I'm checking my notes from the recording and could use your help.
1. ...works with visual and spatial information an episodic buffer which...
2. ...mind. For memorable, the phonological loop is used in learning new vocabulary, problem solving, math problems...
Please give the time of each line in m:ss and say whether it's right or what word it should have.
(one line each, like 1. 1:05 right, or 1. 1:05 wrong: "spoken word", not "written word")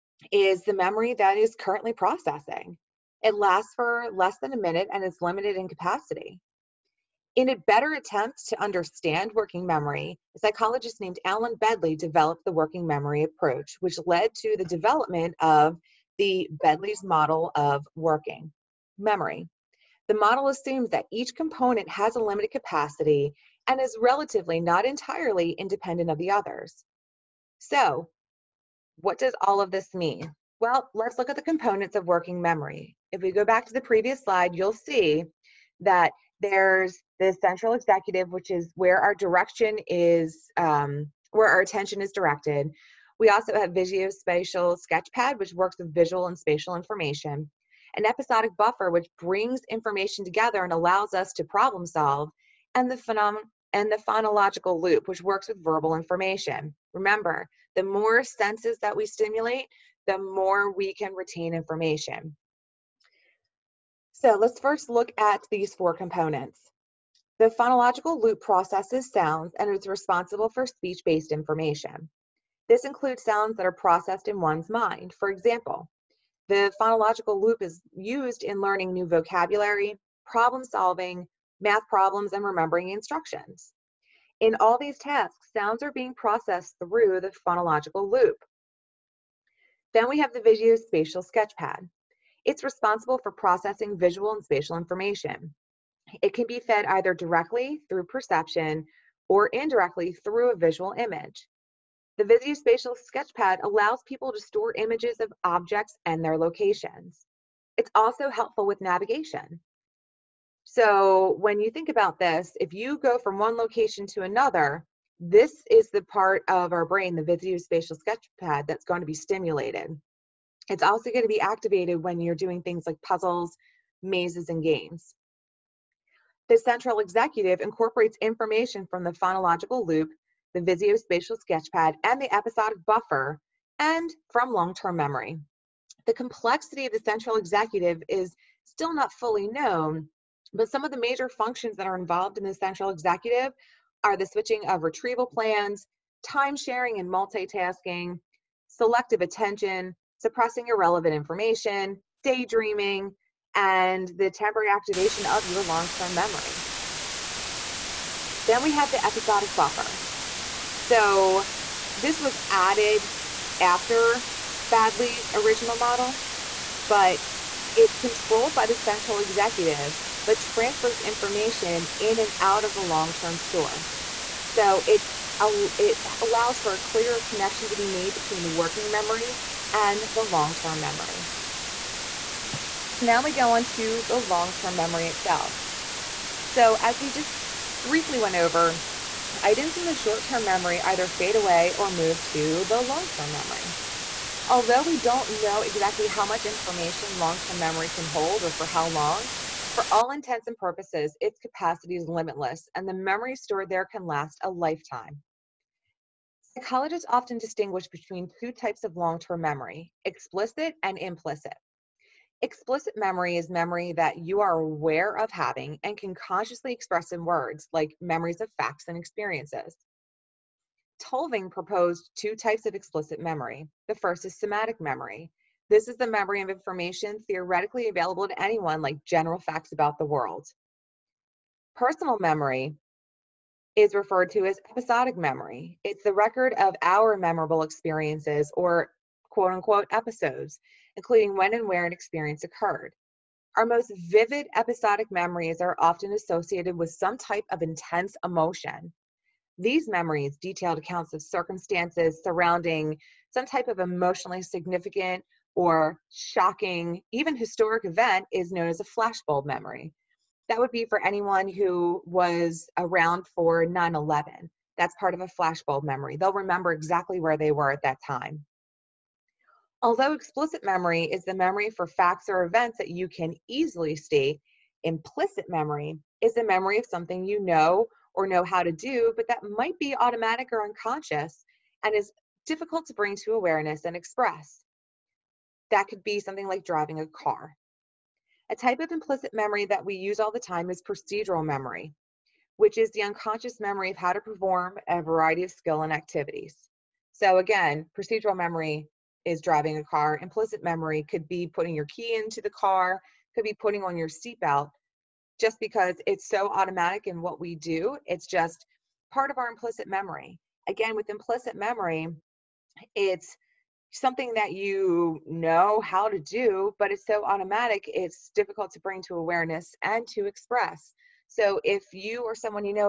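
1. 0:45 right
2. 1:14 wrong: "example", not "memorable".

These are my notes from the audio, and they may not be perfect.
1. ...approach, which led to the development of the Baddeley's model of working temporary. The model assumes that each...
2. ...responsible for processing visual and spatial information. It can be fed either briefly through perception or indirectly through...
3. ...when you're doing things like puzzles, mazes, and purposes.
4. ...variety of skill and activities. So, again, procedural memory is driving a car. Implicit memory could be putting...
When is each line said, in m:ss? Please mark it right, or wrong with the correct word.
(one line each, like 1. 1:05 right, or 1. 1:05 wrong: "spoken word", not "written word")
1. 0:13 wrong: "memory", not "temporary"
2. 1:32 wrong: "directly", not "briefly"
3. 2:02 wrong: "games", not "purposes"
4. 4:55 right.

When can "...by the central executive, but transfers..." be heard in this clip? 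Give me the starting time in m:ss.
2:48.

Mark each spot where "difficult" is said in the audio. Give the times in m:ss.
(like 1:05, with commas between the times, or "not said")
4:42, 5:18.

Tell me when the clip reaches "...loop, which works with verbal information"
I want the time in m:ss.
0:54.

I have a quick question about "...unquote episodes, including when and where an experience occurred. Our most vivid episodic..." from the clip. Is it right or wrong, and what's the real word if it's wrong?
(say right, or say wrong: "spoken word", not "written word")
right.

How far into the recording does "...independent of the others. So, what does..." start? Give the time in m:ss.
0:25.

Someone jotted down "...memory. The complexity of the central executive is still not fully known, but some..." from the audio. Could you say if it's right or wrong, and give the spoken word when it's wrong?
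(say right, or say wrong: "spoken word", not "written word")
right.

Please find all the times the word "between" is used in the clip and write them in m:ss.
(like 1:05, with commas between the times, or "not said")
2:58, 3:27.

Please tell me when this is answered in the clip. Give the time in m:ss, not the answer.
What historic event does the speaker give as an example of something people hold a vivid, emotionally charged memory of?
4:23.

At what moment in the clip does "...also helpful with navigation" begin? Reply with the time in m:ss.
1:47.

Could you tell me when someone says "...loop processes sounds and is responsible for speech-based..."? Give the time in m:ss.
1:08.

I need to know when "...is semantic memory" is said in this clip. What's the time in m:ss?
3:44.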